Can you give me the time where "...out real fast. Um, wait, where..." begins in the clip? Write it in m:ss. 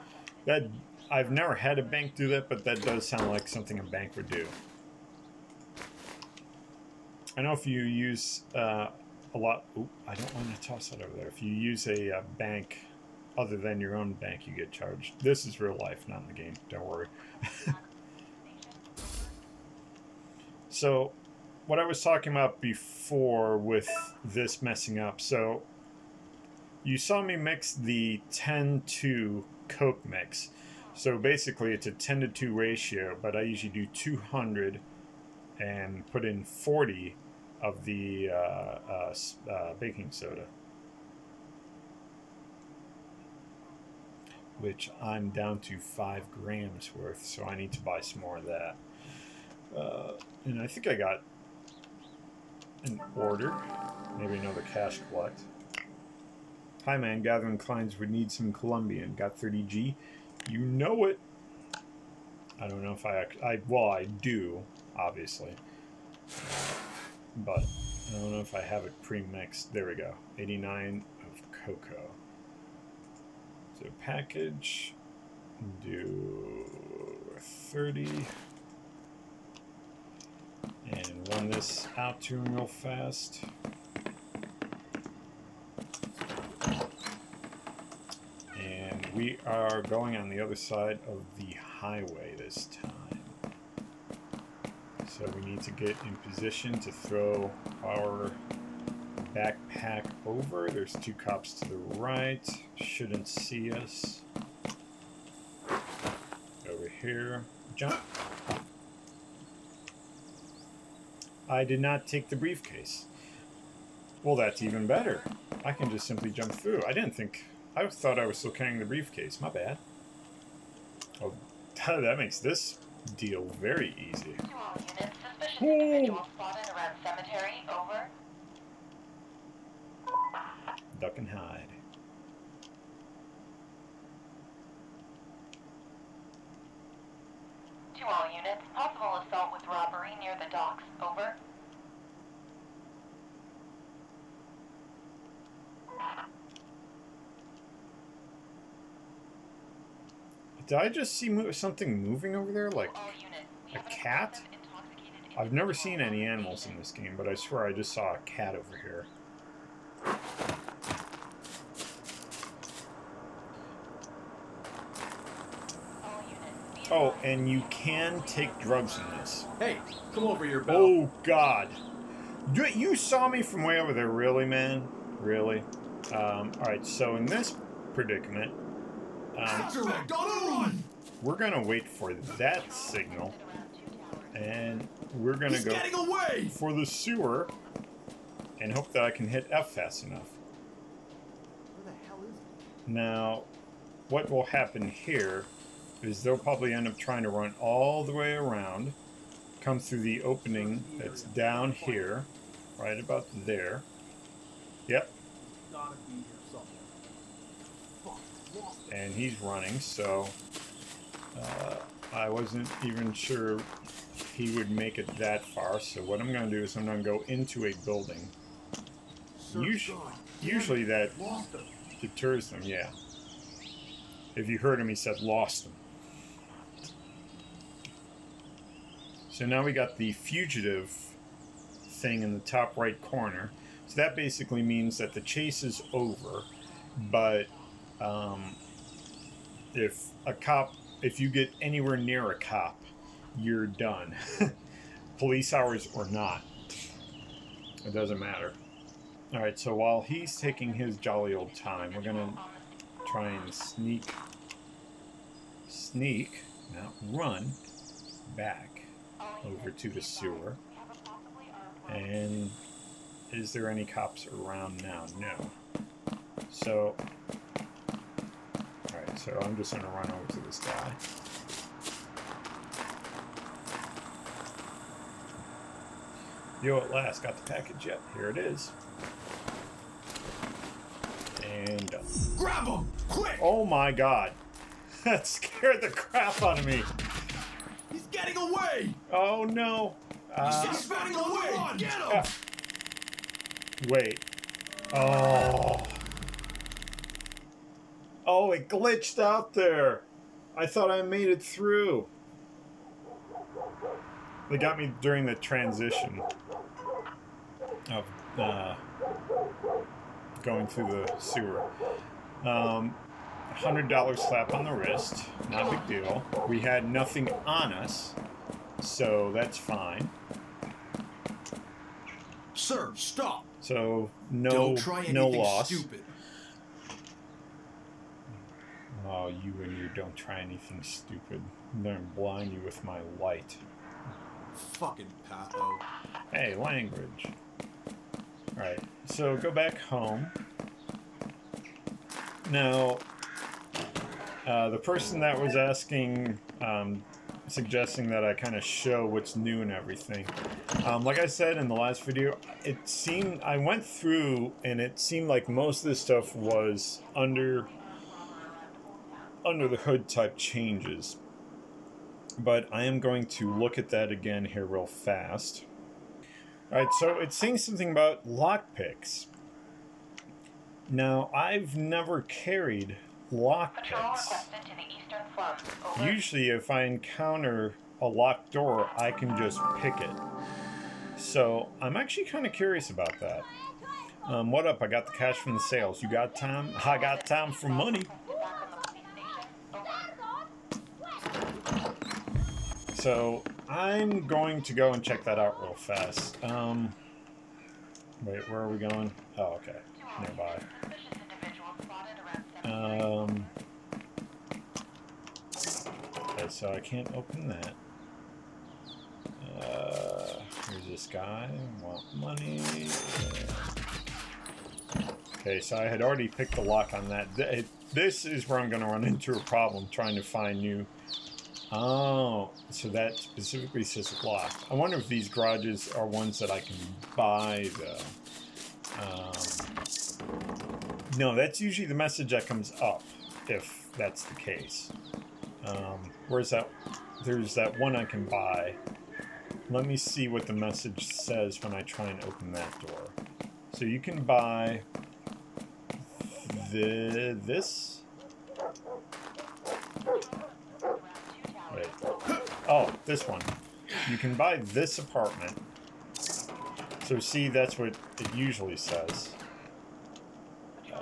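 6:35.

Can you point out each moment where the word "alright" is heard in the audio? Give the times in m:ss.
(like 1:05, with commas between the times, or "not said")
2:56, 4:28, 5:38, 6:06.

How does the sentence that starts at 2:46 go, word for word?
Oh, and you can take drugs in this.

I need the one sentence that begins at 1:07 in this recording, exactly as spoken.
But I don't know if I have it pre-mixed.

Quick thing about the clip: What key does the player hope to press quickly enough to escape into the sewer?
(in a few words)
F.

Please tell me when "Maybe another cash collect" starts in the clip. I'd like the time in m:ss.
0:54.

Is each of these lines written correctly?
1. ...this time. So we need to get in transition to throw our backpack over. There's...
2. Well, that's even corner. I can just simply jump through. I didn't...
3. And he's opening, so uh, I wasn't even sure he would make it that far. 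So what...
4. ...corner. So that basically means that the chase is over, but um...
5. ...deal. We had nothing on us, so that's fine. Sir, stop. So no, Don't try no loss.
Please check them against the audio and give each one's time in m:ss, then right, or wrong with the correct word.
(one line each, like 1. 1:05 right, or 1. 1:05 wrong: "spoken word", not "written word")
1. 1:32 wrong: "position", not "transition"
2. 1:54 wrong: "better", not "corner"
3. 3:28 wrong: "running", not "opening"
4. 3:53 right
5. 5:16 right.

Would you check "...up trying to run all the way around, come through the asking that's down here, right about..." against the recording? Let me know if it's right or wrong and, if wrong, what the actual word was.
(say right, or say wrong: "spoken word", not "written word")
wrong: "opening", not "asking".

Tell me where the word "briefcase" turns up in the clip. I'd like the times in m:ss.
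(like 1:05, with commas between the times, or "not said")
1:52, 1:58.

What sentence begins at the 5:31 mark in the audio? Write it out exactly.
I'm gonna blind you with my light.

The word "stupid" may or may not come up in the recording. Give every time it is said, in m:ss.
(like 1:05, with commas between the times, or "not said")
5:25, 5:30.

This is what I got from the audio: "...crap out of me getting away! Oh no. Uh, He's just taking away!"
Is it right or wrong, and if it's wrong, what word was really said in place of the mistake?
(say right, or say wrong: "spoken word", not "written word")
wrong: "running", not "taking".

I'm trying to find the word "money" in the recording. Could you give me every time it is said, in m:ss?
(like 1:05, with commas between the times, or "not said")
6:27, 6:52.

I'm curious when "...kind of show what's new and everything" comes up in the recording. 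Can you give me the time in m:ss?
5:48.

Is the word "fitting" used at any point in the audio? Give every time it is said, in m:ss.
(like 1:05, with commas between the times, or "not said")
not said.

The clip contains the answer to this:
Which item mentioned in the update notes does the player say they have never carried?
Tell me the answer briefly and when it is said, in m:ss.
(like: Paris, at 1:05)
Lock picks, at 6:13.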